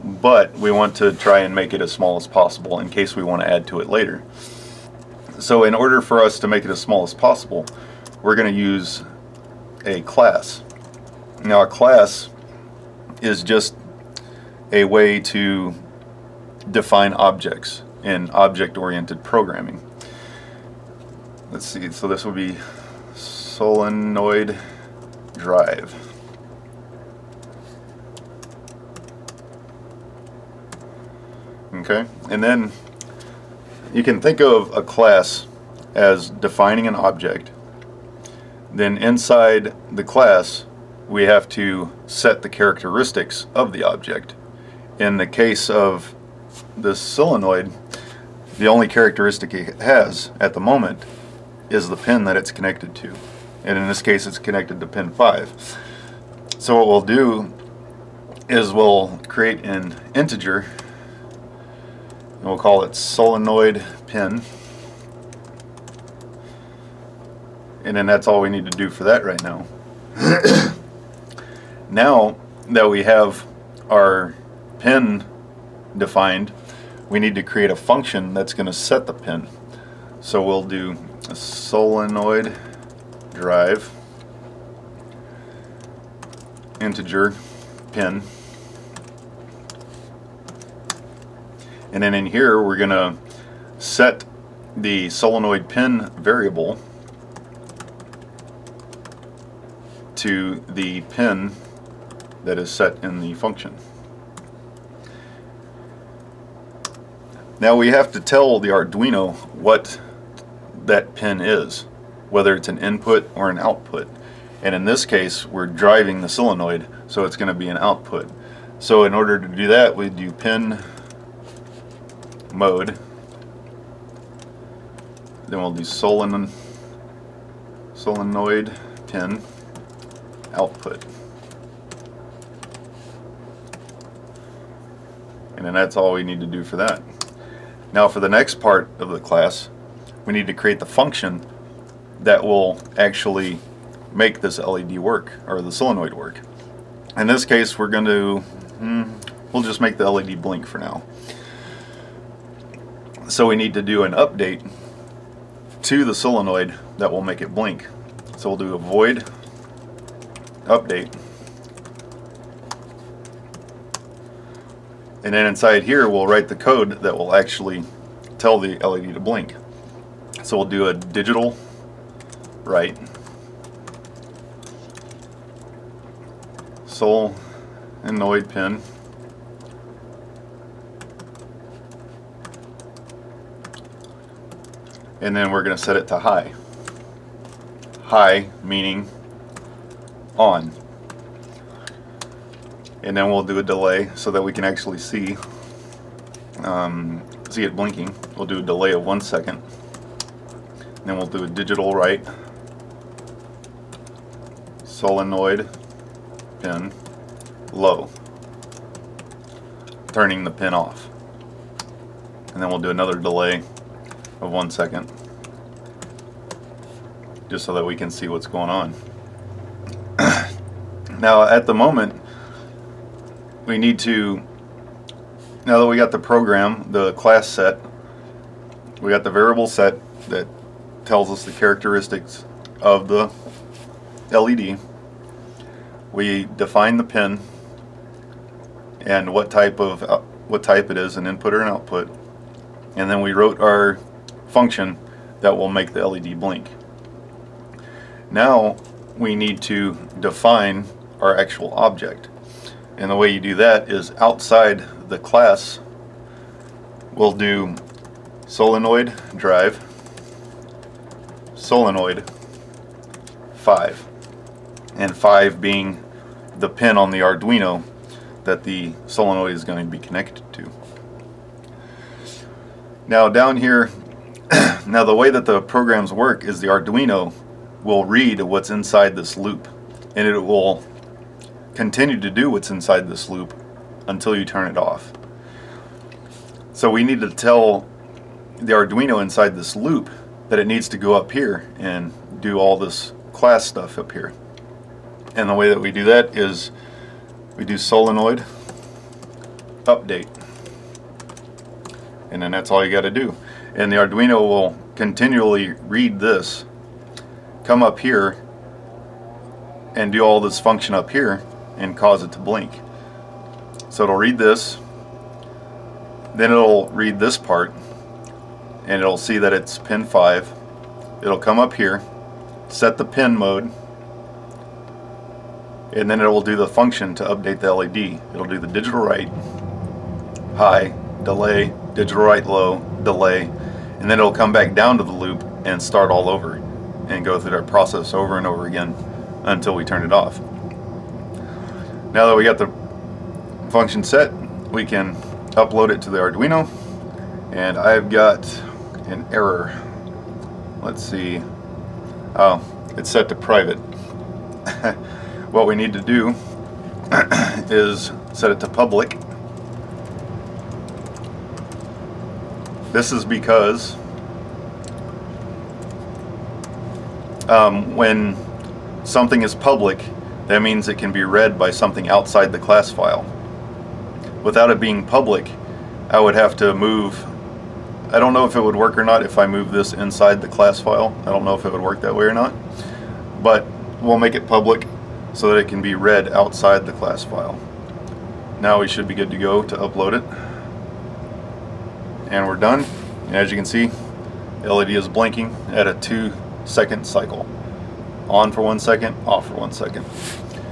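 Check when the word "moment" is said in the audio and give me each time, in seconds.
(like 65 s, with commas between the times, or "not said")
50 s, 221 s.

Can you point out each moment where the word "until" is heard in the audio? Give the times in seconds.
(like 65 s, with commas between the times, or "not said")
284 s, 339 s.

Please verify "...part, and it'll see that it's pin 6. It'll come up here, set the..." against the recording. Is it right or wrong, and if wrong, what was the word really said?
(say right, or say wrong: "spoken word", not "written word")
wrong: "5", not "6".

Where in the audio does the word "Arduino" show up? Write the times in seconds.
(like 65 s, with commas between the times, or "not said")
108 s, 267 s, 276 s, 288 s, 303 s, 346 s.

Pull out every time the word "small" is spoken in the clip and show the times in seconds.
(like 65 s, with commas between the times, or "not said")
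1 s, 6 s.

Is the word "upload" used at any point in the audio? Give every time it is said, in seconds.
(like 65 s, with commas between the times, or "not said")
345 s, 389 s.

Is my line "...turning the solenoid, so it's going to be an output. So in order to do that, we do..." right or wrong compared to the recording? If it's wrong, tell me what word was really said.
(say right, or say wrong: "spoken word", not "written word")
wrong: "driving", not "turning".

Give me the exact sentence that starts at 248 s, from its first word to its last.
Now we need to define our actual object.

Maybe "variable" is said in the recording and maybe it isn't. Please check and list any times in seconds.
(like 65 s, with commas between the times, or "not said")
96 s, 229 s.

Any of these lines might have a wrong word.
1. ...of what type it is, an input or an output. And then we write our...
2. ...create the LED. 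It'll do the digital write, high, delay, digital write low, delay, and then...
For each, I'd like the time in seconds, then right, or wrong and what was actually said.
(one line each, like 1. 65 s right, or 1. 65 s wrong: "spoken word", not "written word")
1. 239 s wrong: "wrote", not "write"
2. 327 s wrong: "update", not "create".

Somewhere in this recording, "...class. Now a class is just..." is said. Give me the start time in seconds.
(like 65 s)
10 s.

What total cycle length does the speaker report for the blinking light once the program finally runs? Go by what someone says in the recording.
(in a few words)
2 seconds.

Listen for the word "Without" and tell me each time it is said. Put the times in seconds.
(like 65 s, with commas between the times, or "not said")
374 s.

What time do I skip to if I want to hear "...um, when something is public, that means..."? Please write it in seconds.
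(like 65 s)
367 s.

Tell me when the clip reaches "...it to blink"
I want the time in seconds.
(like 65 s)
312 s.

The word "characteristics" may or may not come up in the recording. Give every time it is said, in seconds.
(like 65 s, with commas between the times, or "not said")
42 s, 48 s, 231 s.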